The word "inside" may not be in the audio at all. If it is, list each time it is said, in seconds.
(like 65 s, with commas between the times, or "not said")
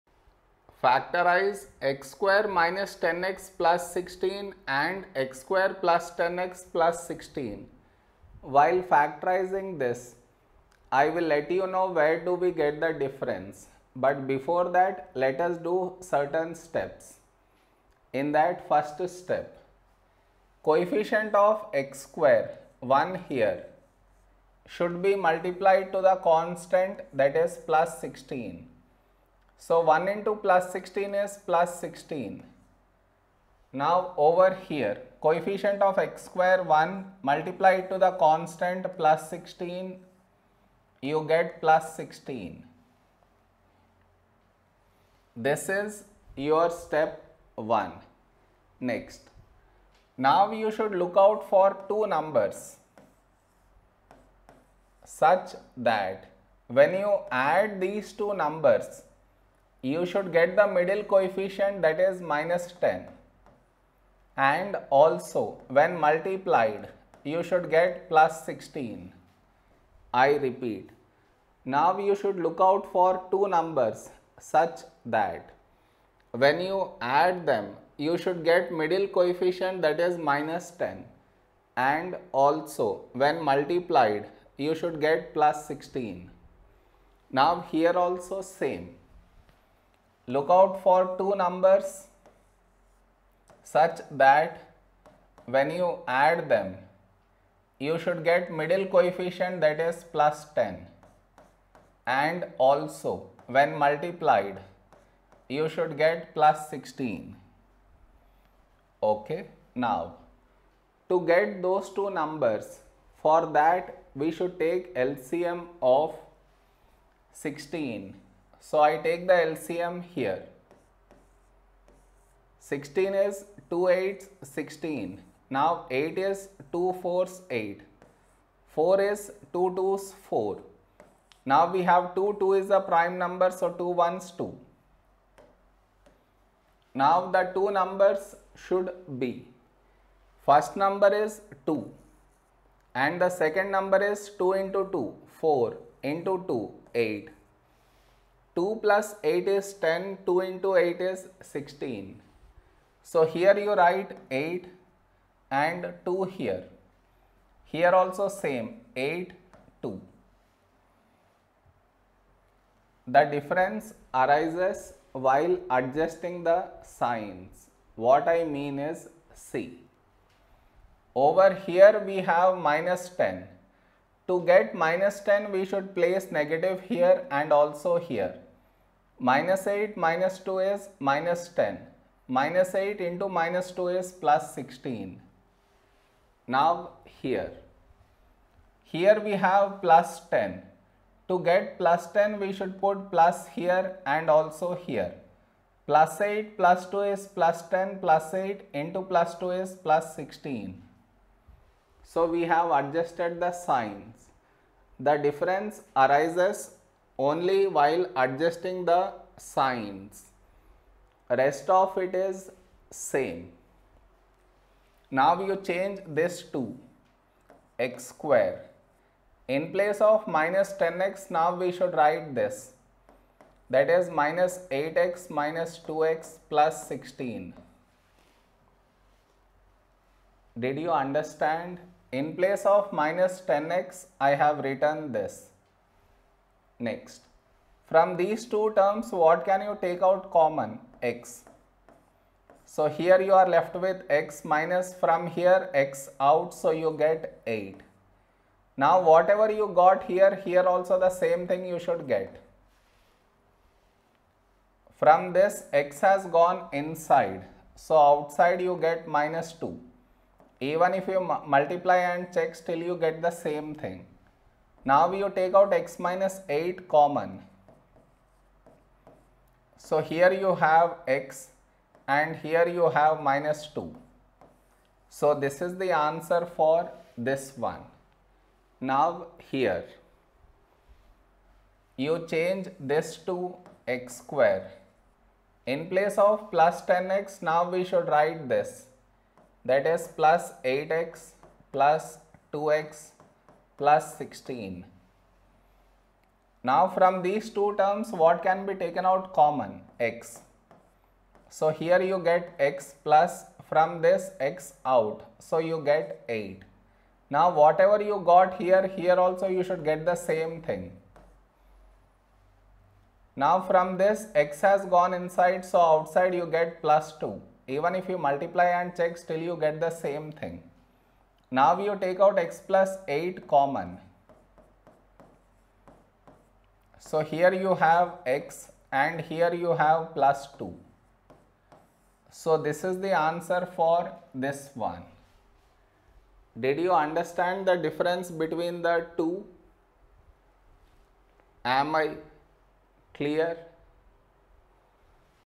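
256 s, 315 s.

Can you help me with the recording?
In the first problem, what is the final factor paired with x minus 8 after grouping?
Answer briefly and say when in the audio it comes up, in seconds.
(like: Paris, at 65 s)
x - 2, at 271 s.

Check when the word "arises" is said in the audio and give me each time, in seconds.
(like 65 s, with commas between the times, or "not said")
164 s, 205 s.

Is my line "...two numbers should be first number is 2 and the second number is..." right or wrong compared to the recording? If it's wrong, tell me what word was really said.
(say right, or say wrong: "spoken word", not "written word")
right.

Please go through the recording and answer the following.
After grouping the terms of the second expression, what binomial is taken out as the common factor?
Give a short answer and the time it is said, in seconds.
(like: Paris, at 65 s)
x + 8, at 322 s.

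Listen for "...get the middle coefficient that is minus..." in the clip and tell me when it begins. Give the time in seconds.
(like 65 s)
60 s.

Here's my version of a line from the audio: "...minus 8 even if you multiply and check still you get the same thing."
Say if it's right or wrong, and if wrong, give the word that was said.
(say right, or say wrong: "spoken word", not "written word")
wrong: "2", not "8".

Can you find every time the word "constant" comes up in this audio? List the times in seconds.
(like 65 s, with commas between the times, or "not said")
26 s, 38 s.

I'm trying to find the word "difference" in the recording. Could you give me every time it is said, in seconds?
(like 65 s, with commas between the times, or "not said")
12 s, 163 s, 205 s, 337 s.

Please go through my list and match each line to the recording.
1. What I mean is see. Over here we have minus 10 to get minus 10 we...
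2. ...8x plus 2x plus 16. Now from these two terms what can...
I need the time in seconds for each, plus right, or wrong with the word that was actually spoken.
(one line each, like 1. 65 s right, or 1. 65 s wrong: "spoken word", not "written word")
1. 167 s right
2. 290 s right.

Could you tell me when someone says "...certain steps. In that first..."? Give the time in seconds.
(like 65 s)
15 s.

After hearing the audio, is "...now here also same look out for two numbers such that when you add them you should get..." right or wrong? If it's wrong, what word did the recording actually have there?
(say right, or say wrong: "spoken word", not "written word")
right.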